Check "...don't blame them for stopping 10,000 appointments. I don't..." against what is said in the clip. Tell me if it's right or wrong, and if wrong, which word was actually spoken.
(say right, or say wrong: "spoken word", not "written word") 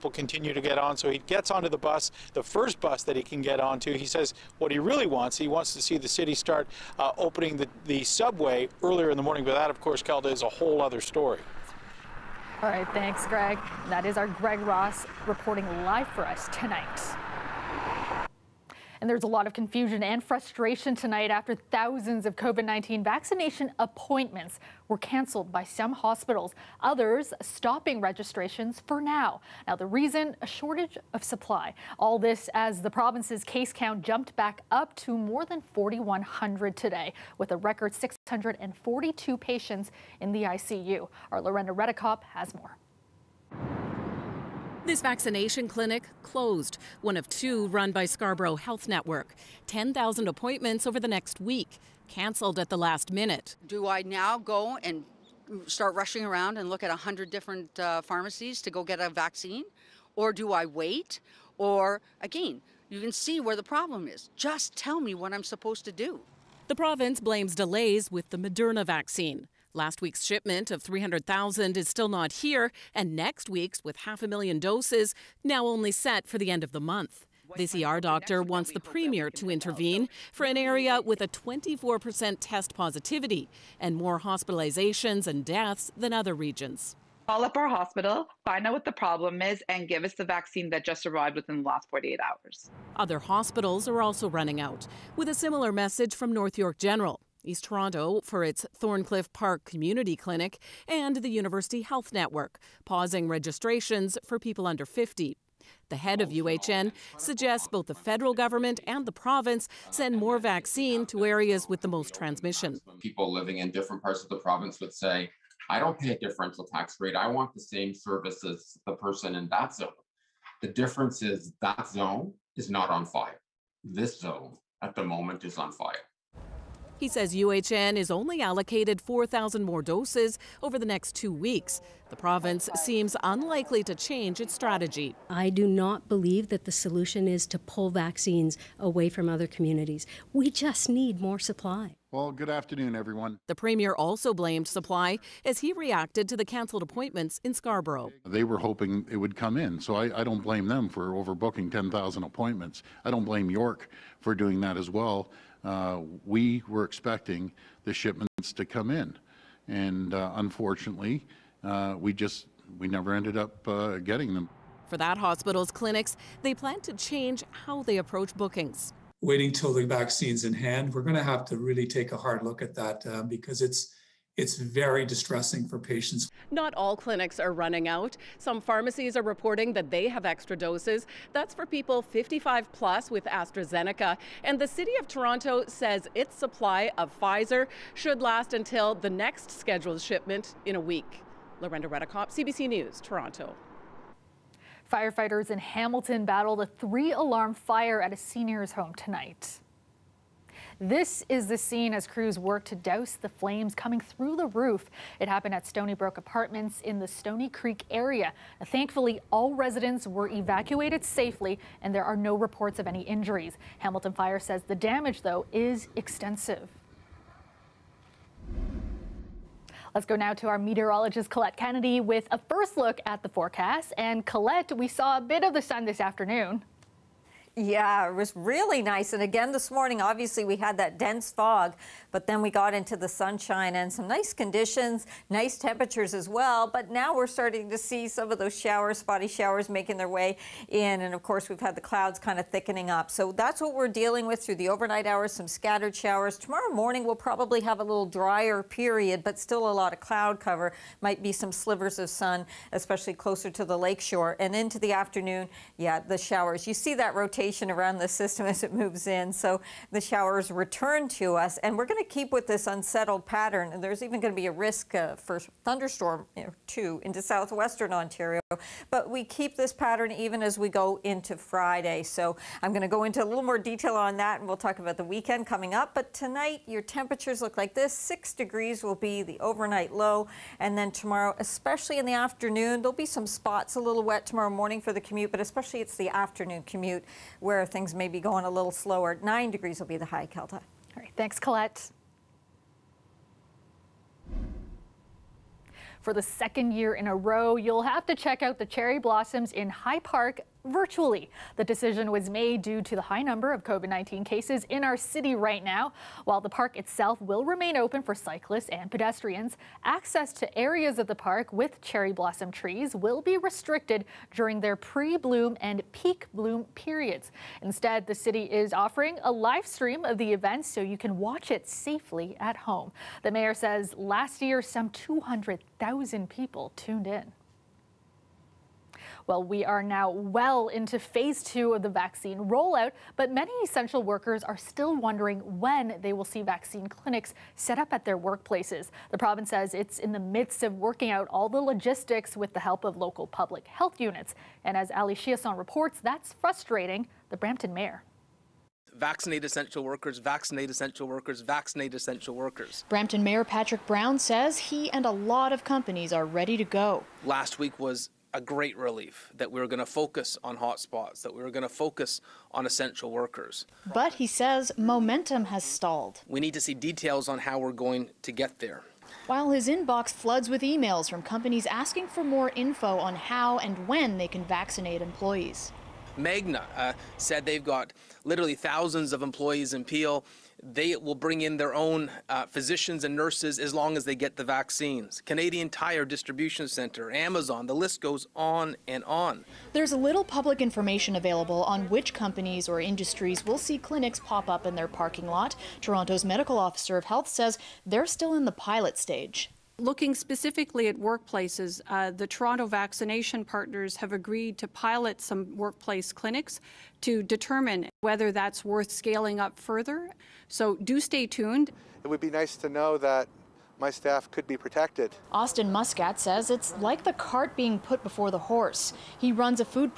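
wrong: "overbooking", not "stopping".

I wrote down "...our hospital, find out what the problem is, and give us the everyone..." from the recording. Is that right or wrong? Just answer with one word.
wrong.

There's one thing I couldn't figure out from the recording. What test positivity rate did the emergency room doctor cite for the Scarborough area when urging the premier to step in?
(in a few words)
24%.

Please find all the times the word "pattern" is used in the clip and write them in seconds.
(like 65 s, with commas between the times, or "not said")
263 s, 269 s.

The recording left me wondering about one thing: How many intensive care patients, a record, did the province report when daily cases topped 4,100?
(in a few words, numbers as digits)
642.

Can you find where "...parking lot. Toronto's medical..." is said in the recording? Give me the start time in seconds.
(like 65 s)
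394 s.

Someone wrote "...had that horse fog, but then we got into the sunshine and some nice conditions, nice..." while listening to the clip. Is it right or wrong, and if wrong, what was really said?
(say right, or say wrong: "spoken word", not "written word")
wrong: "dense", not "horse".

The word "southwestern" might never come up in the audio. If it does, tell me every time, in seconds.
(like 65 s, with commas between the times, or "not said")
267 s.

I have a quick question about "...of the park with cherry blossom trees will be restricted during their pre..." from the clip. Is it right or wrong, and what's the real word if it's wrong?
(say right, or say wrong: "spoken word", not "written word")
right.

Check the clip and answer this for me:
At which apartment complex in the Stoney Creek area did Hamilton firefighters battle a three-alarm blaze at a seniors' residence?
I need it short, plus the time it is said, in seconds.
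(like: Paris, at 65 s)
Stony Brook Apartments, at 205 s.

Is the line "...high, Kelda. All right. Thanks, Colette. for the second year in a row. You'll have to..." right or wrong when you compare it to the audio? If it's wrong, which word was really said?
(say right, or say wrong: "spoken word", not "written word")
right.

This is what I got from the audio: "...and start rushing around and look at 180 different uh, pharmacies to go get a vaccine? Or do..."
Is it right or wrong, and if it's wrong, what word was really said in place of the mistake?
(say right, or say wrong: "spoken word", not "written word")
wrong: "100", not "180".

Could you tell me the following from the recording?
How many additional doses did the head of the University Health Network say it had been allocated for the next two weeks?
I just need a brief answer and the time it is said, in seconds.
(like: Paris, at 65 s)
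4,000, at 129 s.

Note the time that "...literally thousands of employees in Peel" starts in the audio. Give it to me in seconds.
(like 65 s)
378 s.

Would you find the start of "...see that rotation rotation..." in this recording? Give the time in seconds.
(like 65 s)
256 s.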